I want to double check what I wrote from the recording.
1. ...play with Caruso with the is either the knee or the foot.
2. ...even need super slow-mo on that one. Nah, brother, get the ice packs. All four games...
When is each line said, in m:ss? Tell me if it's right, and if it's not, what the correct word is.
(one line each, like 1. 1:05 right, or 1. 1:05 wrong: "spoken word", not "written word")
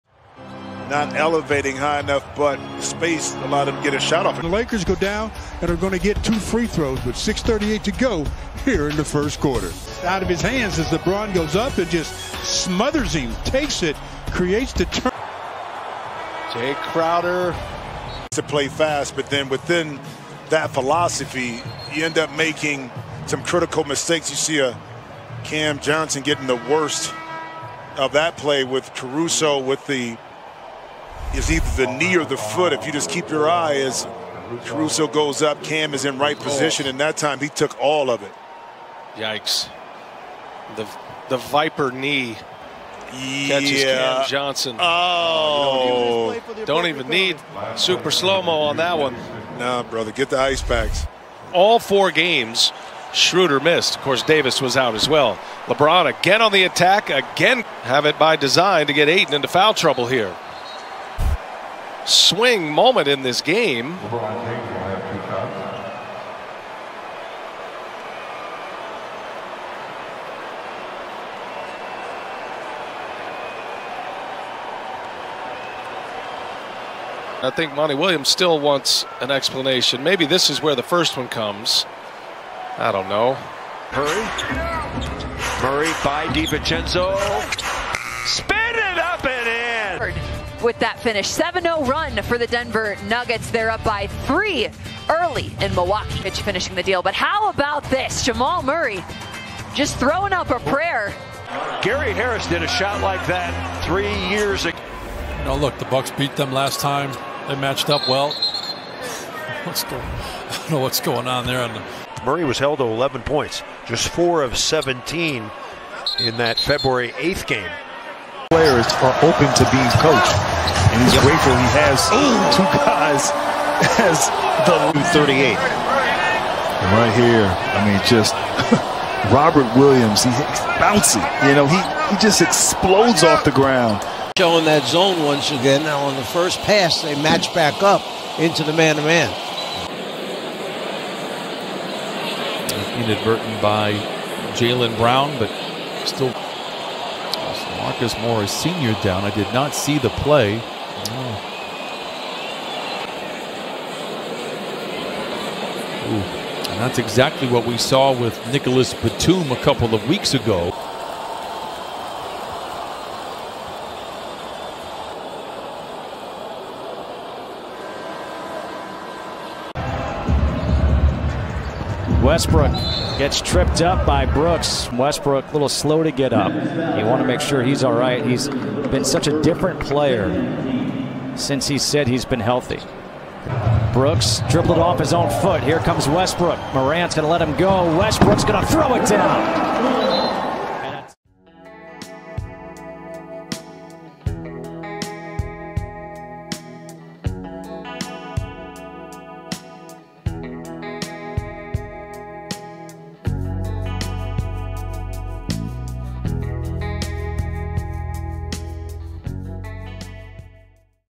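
1. 0:28 right
2. 0:46 right.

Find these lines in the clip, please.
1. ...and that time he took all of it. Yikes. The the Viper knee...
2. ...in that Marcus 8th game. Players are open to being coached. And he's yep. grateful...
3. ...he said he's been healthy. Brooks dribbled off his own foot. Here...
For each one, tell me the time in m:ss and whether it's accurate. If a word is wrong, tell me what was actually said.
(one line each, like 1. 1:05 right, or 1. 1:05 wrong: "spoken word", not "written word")
1. 0:36 right
2. 1:56 wrong: "February", not "Marcus"
3. 3:01 right.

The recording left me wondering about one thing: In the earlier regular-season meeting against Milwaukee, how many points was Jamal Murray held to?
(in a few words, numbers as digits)
11.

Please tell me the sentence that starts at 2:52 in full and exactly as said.
Westbrook gets tripped up by Brooks.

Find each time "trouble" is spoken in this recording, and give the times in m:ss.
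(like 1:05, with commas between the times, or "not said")
0:59.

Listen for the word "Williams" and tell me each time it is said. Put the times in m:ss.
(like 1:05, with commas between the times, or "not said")
1:17, 2:09.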